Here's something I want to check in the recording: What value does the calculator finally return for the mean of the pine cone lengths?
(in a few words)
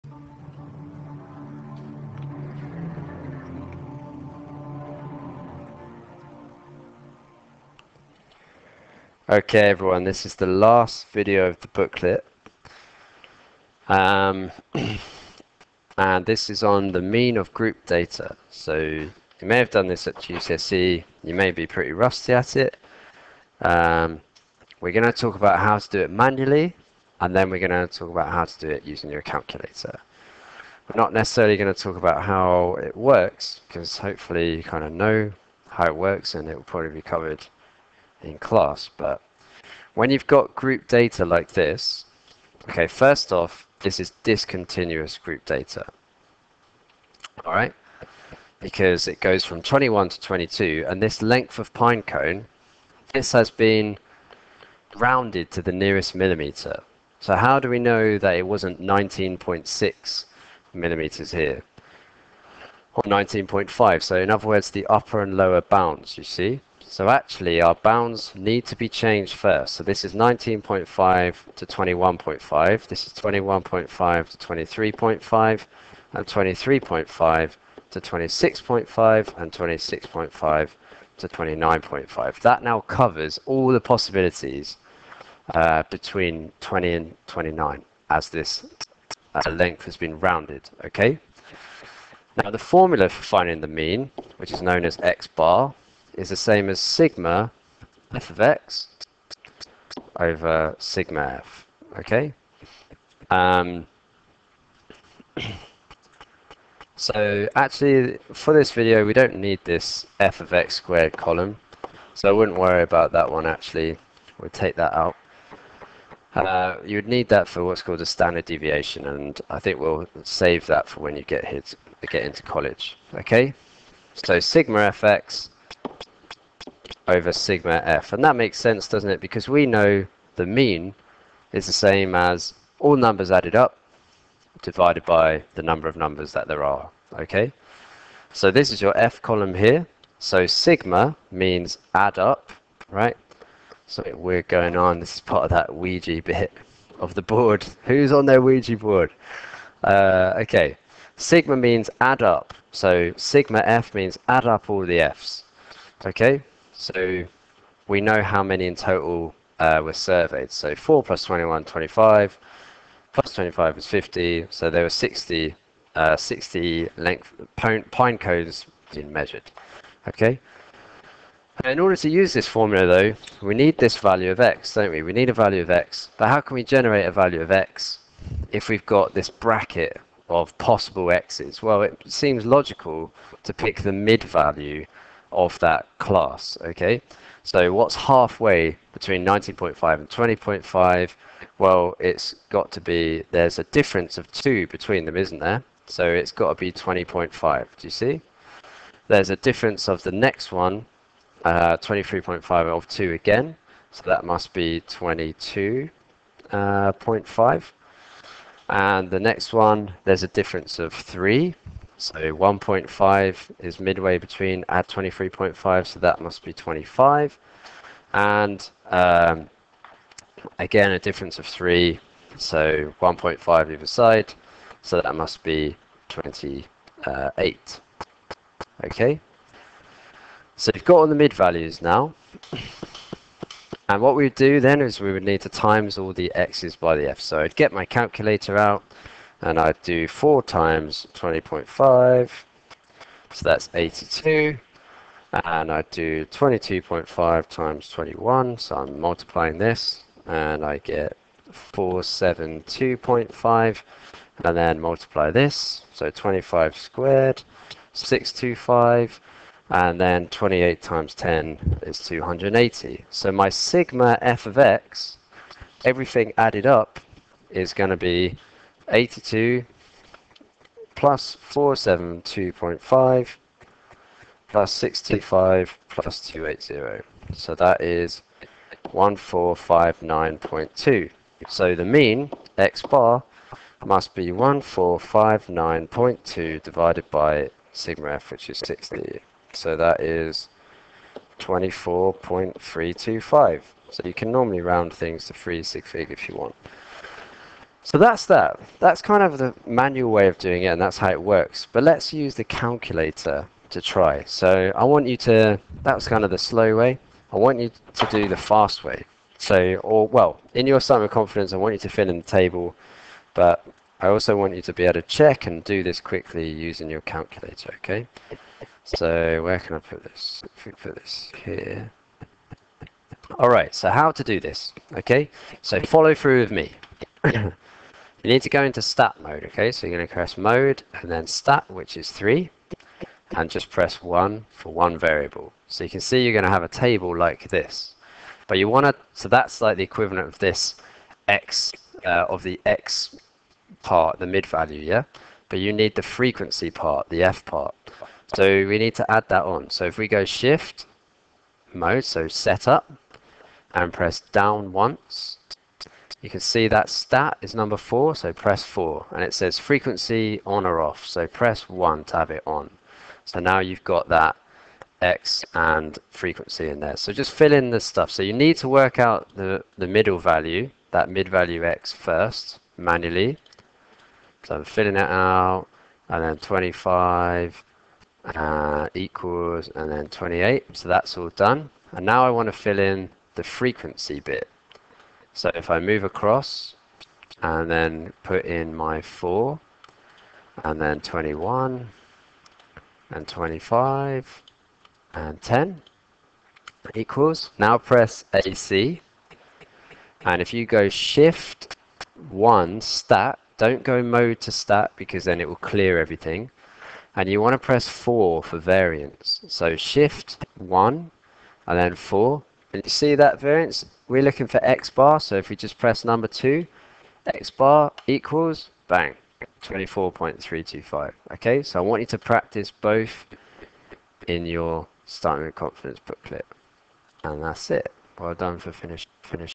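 24.325.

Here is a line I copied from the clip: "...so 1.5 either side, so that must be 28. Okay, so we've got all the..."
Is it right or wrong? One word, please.
right.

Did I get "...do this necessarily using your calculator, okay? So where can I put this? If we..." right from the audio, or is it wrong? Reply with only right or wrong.
wrong.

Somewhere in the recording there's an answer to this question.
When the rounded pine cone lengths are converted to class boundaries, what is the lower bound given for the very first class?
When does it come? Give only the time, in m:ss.
1:10.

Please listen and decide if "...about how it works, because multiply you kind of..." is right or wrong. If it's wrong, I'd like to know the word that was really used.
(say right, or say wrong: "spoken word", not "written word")
wrong: "hopefully", not "multiply".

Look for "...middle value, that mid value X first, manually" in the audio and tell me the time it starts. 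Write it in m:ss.
6:09.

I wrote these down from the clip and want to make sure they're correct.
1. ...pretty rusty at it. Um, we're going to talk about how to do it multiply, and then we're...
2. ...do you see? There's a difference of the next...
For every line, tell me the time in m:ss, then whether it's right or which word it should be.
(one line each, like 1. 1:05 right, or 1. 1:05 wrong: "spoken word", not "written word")
1. 0:21 wrong: "manually", not "multiply"
2. 3:17 right.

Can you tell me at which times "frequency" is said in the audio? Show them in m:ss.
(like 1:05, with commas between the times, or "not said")
5:46, 5:59, 6:06, 6:23.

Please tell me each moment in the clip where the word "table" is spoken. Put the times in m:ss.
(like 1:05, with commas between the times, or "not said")
5:12, 5:36.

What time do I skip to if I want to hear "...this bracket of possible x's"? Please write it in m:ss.
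2:59.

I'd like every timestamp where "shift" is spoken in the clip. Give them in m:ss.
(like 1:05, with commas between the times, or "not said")
5:50, 6:40, 6:49.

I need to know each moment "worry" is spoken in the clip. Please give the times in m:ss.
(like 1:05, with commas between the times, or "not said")
1:52.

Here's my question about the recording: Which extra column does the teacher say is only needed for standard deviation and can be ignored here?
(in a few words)
f of x squared.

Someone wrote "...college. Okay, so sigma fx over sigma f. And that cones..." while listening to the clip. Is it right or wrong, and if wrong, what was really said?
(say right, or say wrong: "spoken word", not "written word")
wrong: "makes", not "cones".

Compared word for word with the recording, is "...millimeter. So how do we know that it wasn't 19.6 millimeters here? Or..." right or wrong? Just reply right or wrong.
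right.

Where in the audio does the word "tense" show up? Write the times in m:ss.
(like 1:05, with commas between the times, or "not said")
not said.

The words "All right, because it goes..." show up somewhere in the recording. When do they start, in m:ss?
0:47.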